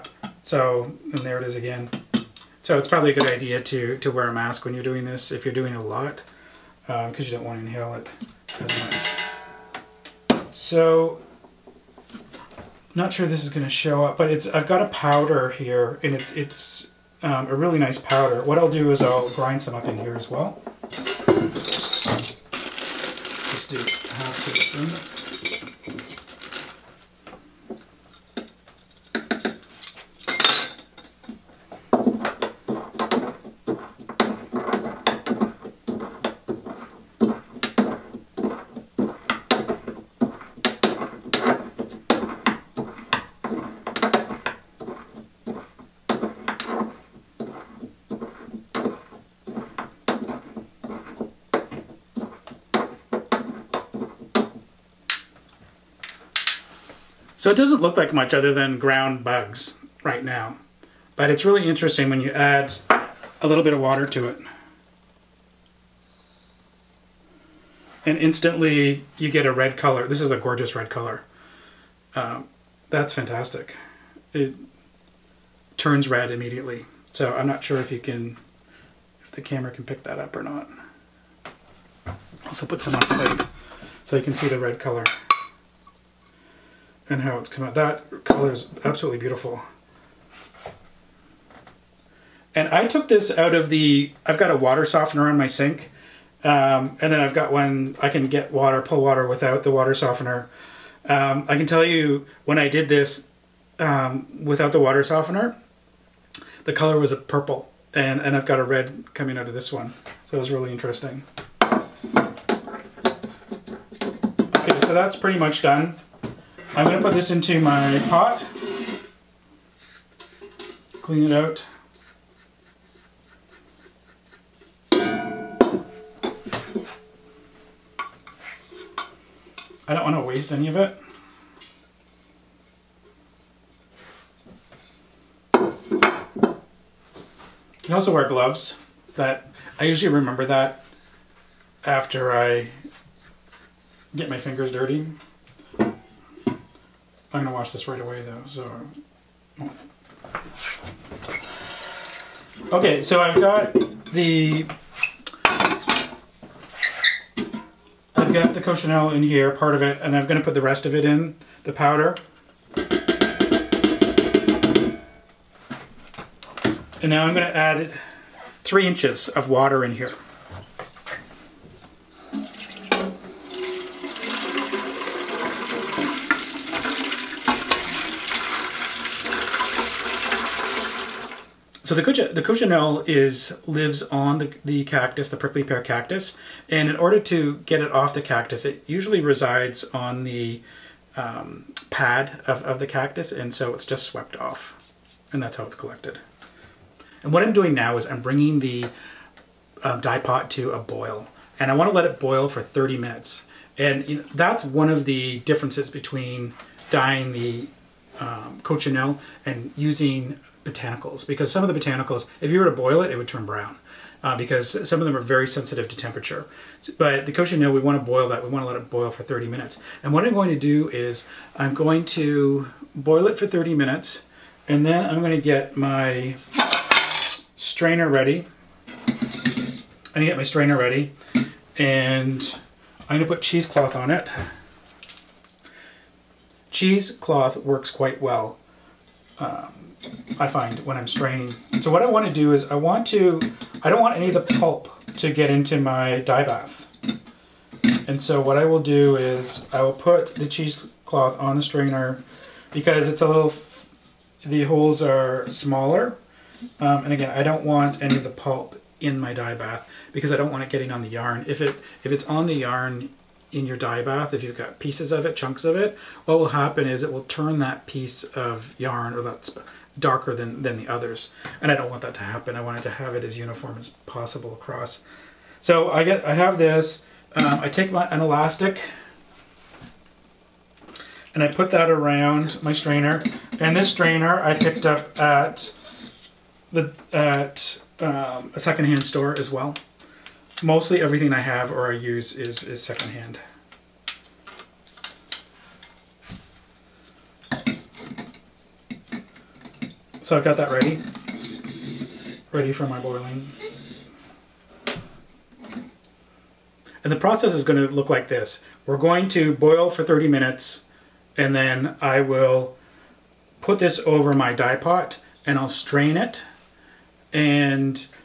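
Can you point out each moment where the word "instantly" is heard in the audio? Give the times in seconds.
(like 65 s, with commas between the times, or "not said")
68 s.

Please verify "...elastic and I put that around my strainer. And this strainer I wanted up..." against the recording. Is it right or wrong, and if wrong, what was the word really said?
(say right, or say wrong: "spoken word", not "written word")
wrong: "picked", not "wanted".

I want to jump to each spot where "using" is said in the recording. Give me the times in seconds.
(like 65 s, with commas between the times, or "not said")
209 s.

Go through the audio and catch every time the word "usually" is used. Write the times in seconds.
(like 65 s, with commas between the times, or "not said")
139 s, 188 s.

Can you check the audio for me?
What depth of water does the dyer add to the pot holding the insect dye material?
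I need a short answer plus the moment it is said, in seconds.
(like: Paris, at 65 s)
3 inches, at 168 s.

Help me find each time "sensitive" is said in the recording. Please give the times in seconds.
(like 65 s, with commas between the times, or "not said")
215 s.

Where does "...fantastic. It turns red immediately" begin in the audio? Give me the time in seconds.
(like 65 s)
73 s.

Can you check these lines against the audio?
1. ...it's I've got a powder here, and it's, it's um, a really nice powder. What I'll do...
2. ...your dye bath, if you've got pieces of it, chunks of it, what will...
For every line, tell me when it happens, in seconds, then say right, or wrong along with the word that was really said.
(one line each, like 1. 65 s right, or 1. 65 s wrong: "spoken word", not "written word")
1. 14 s right
2. 263 s right.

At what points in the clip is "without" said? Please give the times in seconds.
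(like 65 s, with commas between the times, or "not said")
99 s, 104 s.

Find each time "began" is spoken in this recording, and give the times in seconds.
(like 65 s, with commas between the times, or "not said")
not said.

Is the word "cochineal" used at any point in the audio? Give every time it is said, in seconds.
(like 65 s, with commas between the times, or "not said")
158 s, 182 s, 208 s, 217 s.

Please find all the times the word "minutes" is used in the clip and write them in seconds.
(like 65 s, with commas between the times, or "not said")
202 s, 219 s, 223 s, 310 s.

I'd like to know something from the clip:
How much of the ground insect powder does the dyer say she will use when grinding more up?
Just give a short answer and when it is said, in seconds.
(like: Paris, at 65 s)
half a teaspoon, at 23 s.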